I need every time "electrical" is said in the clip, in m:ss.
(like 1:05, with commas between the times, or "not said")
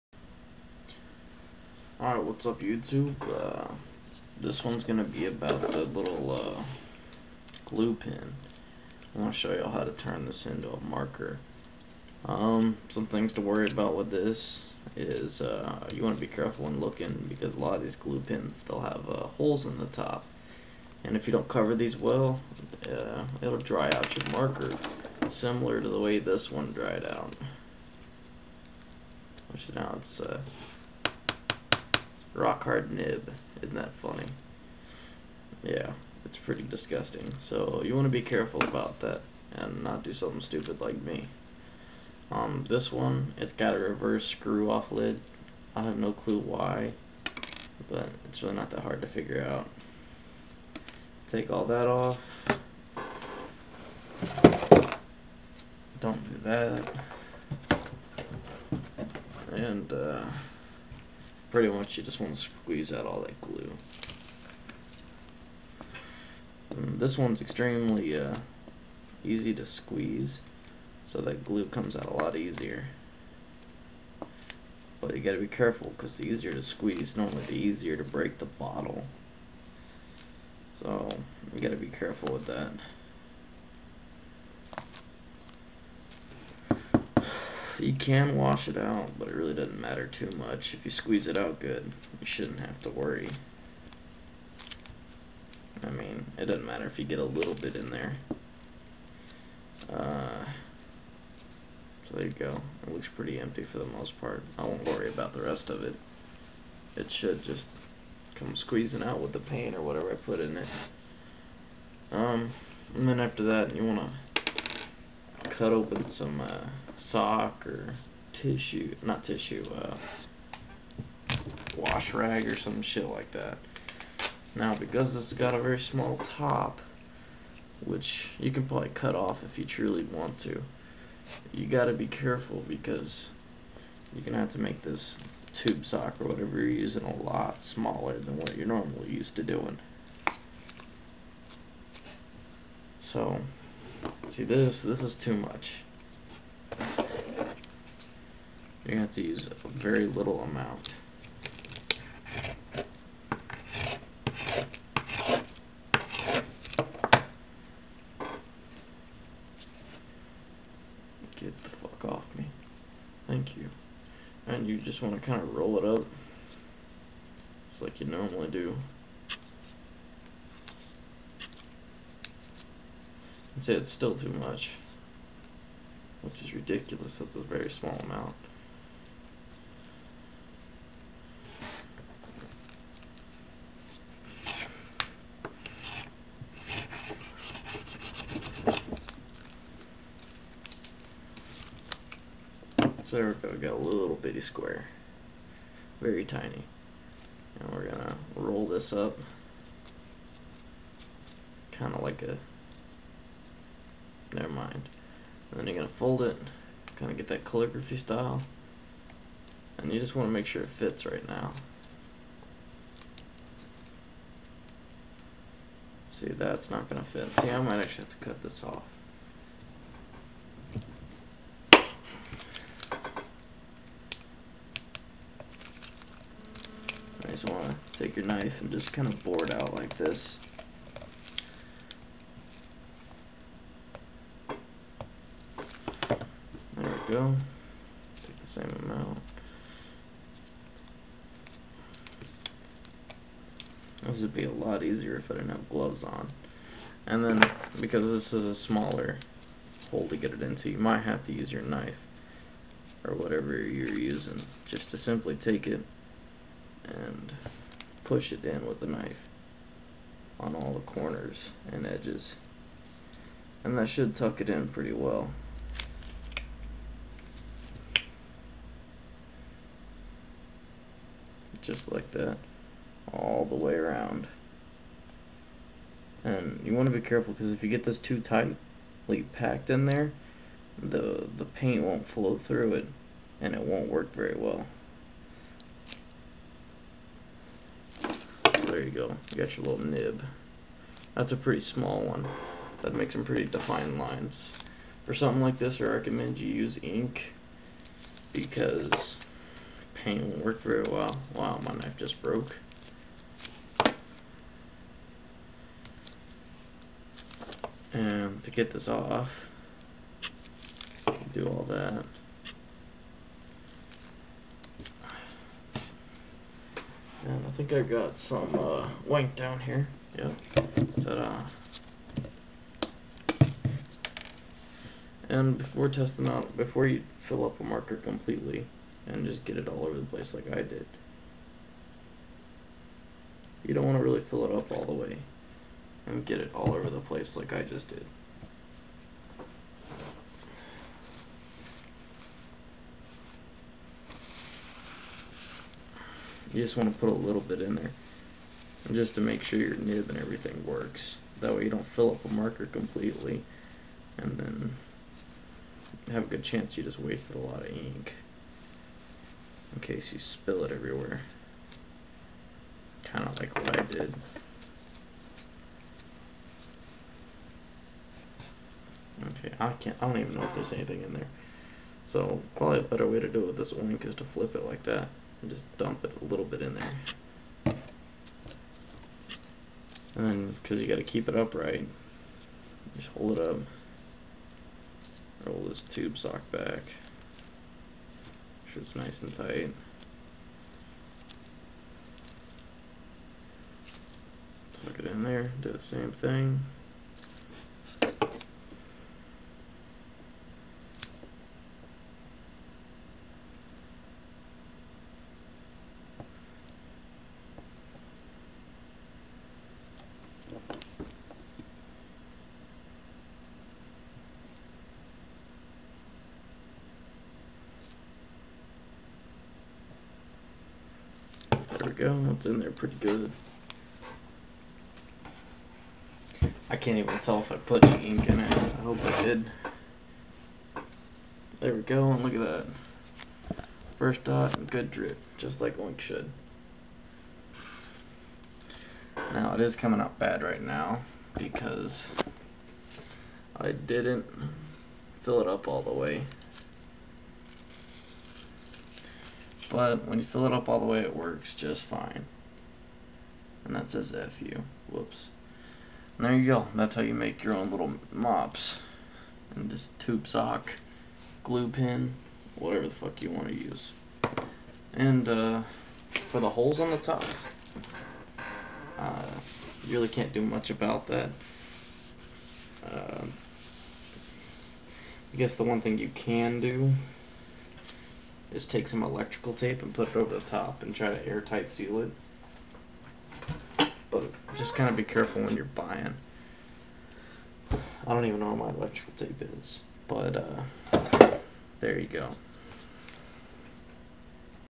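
7:59, 8:08.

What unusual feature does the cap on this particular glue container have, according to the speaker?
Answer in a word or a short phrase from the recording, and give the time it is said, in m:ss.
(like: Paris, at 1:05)
Reverse screw off, at 0:43.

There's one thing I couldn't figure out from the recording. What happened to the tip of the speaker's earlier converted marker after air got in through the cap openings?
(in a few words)
Rock hard nib.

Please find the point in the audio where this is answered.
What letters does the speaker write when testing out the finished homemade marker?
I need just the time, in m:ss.
7:34.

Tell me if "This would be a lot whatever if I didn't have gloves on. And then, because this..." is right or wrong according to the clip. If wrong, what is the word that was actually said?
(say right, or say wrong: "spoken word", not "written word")
wrong: "easier", not "whatever".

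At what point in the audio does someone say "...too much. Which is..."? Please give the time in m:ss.
2:54.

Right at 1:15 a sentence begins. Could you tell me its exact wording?
But you gotta be careful, because the easier to squeeze, normally the easier to break the bottle.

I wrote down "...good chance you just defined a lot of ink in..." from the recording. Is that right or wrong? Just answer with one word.
wrong.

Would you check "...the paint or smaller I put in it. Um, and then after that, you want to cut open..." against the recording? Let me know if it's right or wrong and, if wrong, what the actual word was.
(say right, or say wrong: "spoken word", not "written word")
wrong: "whatever", not "smaller".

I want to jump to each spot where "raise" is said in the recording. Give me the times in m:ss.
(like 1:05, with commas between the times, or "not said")
not said.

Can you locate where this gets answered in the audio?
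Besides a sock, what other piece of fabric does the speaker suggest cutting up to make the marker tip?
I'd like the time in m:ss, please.
2:01.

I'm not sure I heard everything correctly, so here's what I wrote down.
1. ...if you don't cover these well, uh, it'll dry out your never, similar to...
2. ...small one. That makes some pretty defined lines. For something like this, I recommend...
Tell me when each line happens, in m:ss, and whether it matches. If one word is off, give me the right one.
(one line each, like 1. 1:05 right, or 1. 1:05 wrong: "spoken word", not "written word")
1. 0:21 wrong: "marker", not "never"
2. 4:51 right.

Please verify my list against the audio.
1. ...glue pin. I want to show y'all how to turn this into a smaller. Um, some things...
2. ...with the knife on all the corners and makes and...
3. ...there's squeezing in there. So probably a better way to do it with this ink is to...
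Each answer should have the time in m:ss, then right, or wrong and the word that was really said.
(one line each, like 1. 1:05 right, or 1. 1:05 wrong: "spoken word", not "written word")
1. 0:07 wrong: "marker", not "smaller"
2. 4:18 wrong: "edges", not "makes"
3. 6:10 wrong: "anything", not "squeezing".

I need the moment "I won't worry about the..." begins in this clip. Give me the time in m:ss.
1:44.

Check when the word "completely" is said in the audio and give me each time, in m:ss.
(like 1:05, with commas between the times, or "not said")
5:27, 5:52.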